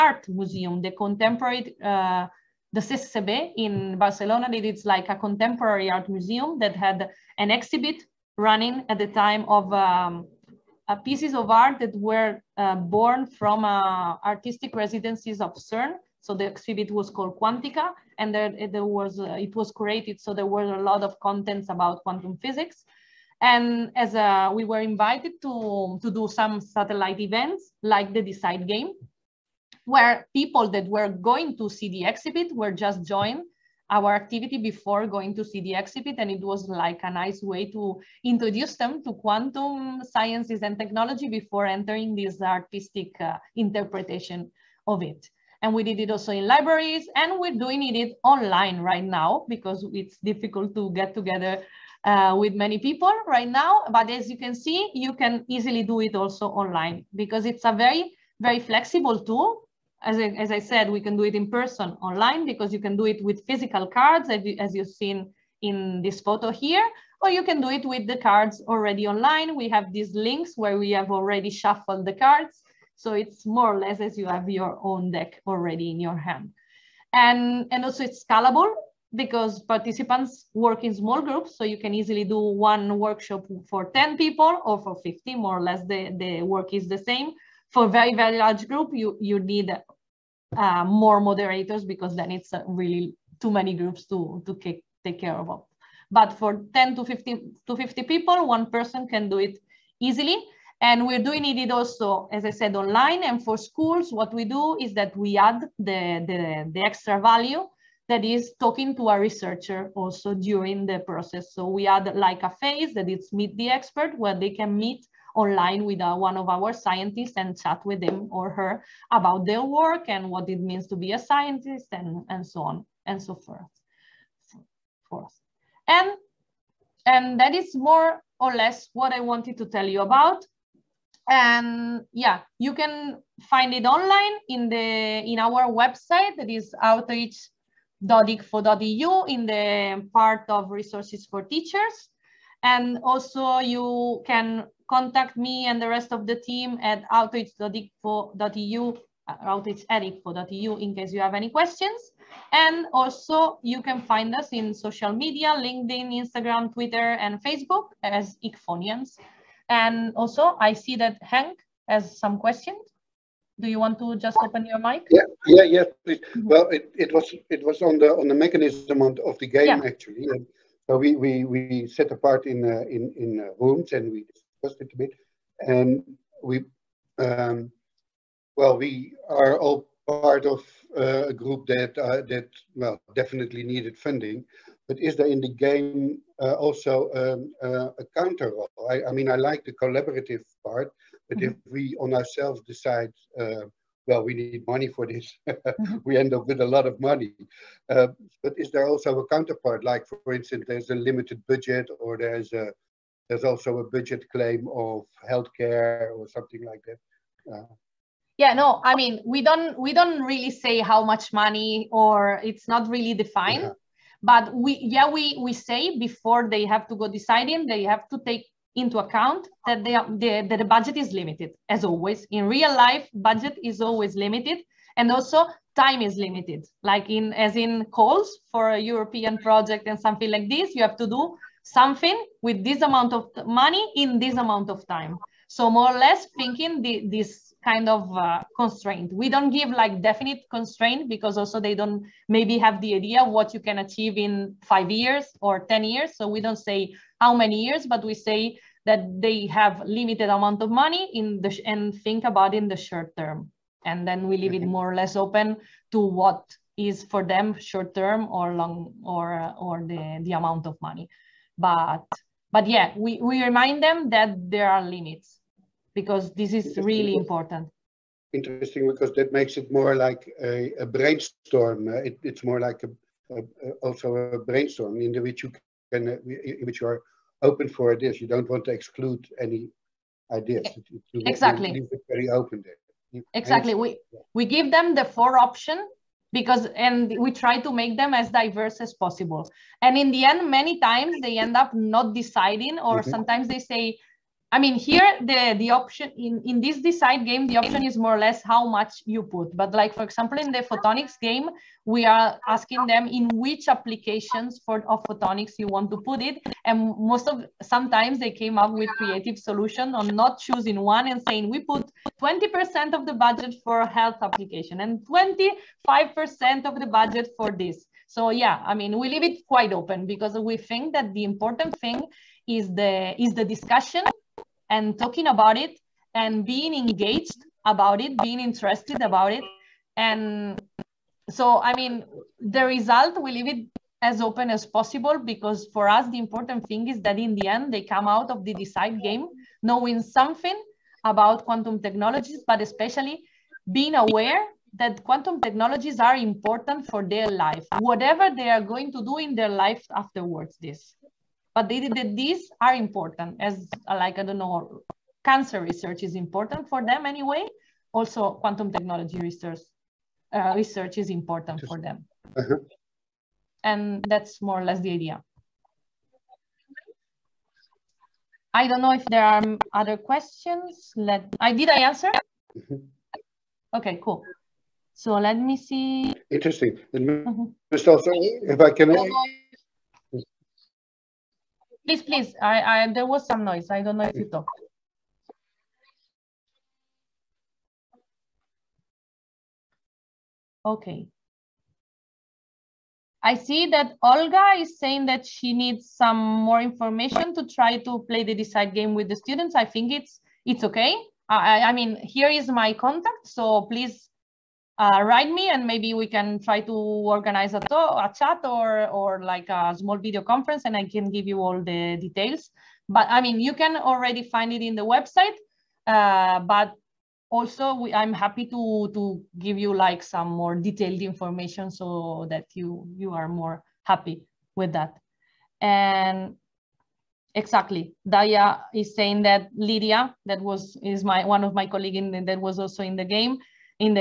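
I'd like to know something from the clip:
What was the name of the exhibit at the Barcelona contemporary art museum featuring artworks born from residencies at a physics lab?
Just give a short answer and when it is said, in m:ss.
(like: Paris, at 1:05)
Quantica, at 0:17.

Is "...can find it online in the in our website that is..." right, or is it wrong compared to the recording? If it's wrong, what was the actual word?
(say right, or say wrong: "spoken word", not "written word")
right.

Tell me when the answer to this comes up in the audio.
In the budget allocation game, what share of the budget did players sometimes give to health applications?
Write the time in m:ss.
5:12.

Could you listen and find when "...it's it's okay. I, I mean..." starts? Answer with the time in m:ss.
6:39.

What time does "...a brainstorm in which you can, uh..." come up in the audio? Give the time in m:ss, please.
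4:34.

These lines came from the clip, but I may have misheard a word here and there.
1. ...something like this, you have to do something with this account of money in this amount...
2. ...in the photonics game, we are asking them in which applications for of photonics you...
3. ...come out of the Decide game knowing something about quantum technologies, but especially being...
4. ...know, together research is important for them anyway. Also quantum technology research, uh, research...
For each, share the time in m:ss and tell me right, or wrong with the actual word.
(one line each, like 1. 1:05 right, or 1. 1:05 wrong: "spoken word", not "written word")
1. 3:49 wrong: "amount", not "account"
2. 5:00 right
3. 5:37 right
4. 5:54 wrong: "cancer", not "together".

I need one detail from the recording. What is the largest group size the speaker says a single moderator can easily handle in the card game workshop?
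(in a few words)
50.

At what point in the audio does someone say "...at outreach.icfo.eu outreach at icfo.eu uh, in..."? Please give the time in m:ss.
2:26.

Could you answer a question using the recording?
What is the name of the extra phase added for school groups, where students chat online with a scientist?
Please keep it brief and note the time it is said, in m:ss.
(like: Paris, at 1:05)
Meet the expert, at 1:53.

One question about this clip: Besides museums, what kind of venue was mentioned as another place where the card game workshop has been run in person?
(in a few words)
Libraries.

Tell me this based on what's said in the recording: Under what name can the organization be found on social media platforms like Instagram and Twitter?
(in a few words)
ICFOnians.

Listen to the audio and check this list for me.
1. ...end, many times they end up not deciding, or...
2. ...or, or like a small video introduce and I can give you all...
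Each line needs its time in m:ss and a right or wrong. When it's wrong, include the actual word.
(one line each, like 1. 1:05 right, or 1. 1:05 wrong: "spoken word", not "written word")
1. 4:50 right
2. 6:48 wrong: "conference", not "introduce".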